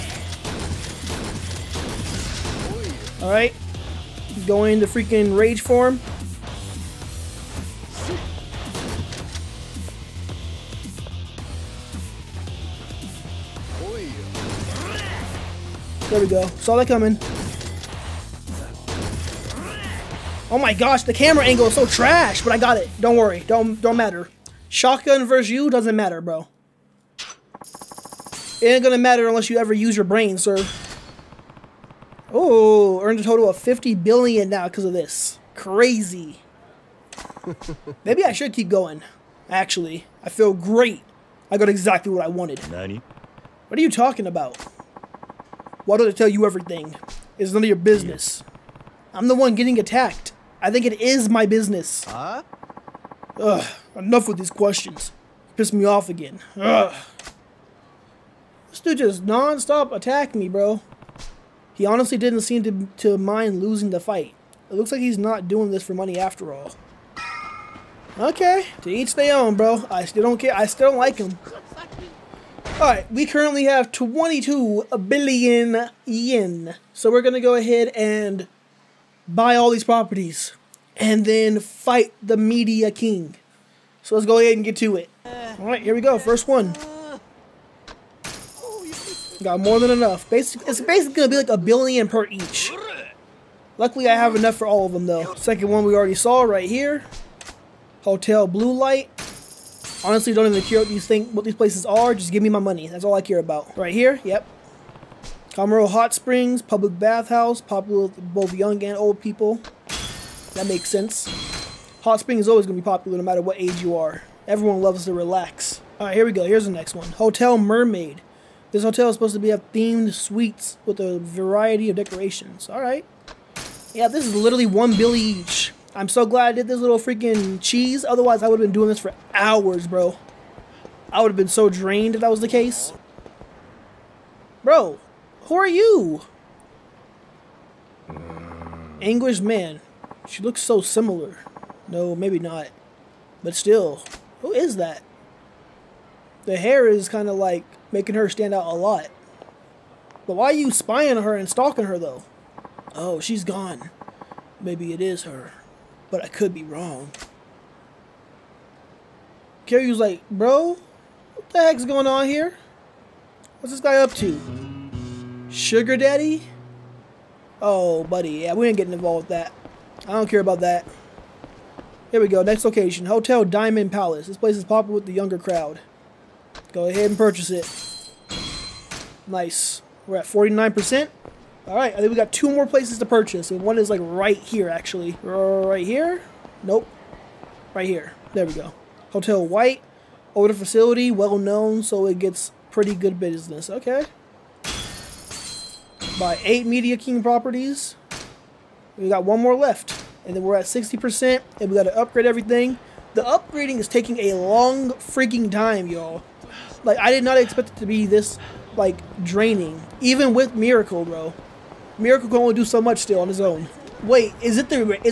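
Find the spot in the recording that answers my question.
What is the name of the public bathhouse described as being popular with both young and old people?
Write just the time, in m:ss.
1:45.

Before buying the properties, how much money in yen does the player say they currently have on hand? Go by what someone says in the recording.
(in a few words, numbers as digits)
22 billion yen.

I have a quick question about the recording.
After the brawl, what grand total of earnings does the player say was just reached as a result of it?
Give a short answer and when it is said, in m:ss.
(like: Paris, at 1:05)
50 billion, at 0:33.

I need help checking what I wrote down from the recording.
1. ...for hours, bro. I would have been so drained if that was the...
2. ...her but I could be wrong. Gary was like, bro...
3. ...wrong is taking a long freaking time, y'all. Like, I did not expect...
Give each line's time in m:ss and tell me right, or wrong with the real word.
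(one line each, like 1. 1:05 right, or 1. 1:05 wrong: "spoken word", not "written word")
1. 2:08 right
2. 2:35 right
3. 3:23 wrong: "upgrading", not "wrong".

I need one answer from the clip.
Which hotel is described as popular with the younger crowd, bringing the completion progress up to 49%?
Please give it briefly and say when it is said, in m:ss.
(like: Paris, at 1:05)
Hotel Diamond Palace, at 2:53.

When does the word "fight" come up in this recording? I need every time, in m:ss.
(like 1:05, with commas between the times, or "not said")
1:03, 1:21.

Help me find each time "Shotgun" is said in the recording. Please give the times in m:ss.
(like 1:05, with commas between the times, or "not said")
0:24.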